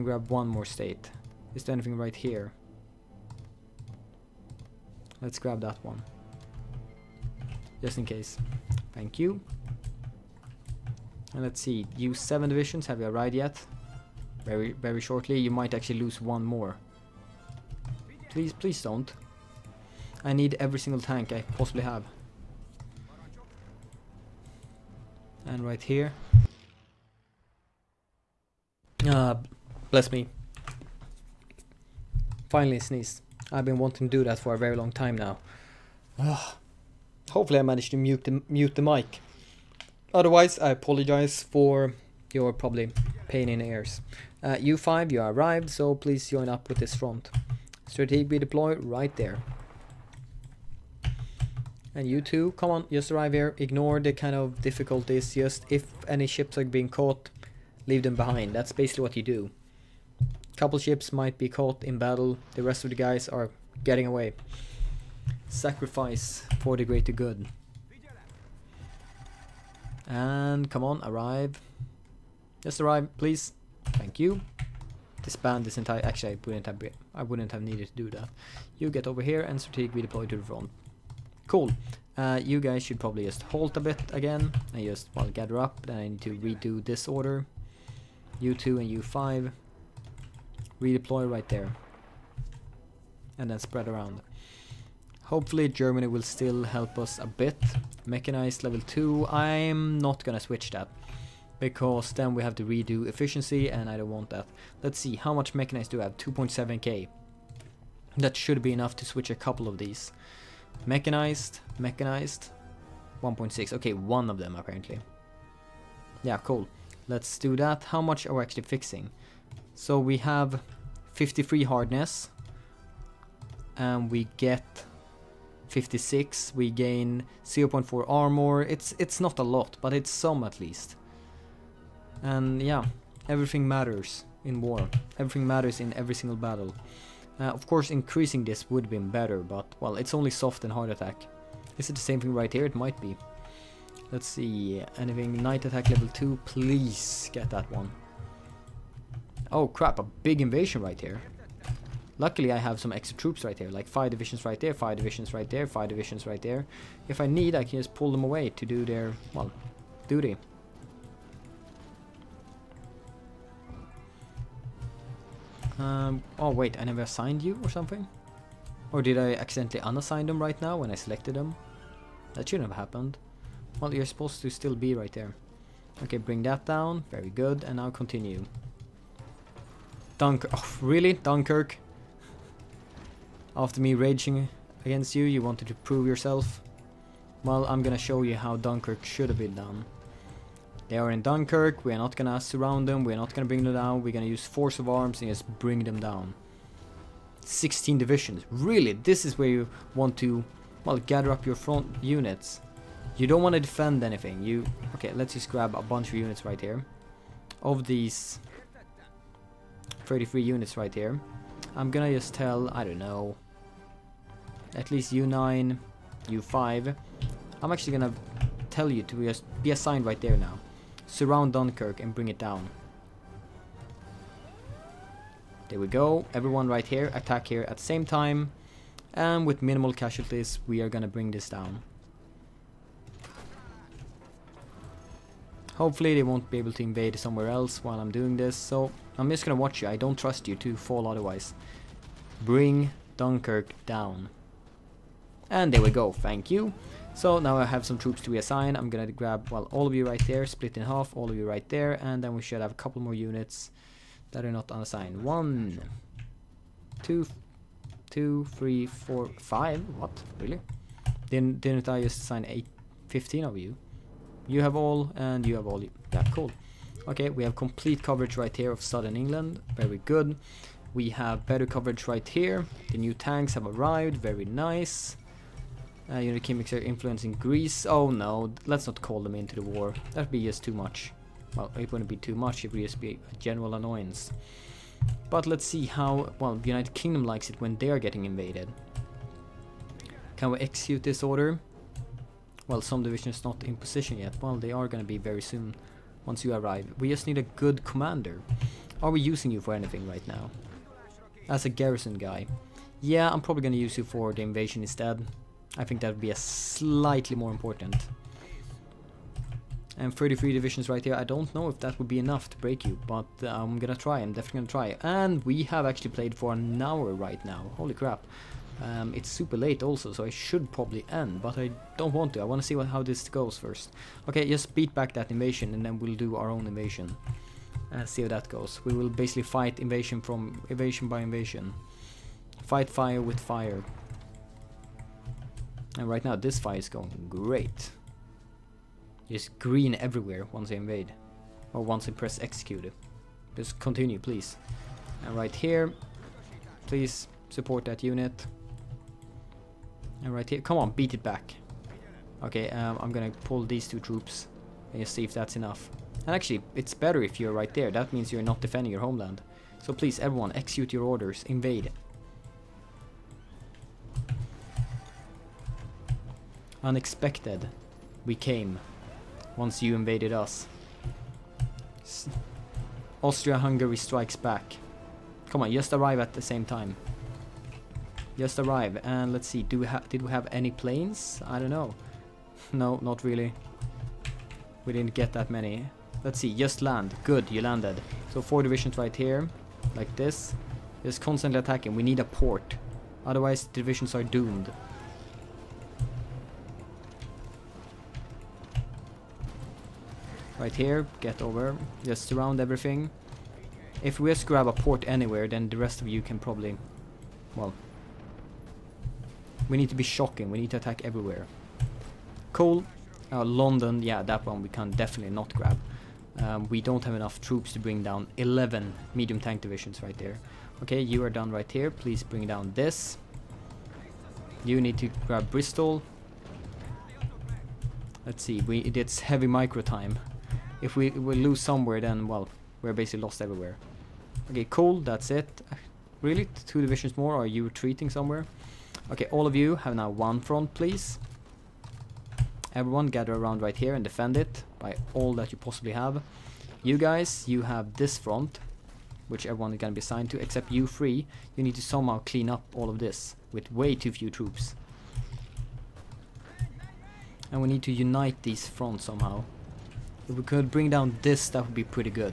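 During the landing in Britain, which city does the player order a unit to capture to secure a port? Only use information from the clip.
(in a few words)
Bristol.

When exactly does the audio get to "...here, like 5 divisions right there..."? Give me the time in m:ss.
2:33.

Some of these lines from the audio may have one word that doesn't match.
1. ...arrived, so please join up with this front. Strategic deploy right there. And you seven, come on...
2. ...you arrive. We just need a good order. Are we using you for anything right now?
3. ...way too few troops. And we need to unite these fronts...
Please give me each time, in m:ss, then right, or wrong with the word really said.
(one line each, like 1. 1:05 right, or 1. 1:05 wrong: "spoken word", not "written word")
1. 0:45 wrong: "two", not "seven"
2. 4:56 wrong: "commander", not "order"
3. 7:33 right.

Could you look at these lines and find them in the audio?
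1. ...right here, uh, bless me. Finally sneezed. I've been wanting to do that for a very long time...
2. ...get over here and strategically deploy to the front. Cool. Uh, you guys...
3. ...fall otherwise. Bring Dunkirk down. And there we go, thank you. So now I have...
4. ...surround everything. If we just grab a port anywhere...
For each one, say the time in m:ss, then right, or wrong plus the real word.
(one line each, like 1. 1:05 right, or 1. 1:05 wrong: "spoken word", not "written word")
1. 0:25 right
2. 1:18 right
3. 4:00 right
4. 6:42 right.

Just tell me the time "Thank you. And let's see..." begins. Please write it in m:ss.
0:08.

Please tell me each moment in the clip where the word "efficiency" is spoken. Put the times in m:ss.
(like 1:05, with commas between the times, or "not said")
1:43.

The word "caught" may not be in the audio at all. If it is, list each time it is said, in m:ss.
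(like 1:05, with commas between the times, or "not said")
0:56, 1:01.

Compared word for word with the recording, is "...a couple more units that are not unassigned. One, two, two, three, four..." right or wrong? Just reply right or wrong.
right.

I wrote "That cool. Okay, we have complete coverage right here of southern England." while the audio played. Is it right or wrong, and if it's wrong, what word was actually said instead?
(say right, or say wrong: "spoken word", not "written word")
right.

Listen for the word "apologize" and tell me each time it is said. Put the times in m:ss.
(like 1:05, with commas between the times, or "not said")
0:40.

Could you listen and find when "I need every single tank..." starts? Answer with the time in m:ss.
0:20.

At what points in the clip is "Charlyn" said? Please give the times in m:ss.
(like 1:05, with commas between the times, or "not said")
not said.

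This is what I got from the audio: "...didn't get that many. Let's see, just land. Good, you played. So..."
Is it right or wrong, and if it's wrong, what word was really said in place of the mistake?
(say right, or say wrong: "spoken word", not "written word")
wrong: "landed", not "played".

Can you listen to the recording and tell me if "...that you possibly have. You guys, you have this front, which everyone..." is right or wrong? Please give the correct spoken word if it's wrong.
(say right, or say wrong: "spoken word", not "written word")
right.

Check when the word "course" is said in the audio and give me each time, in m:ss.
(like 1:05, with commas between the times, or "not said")
2:17.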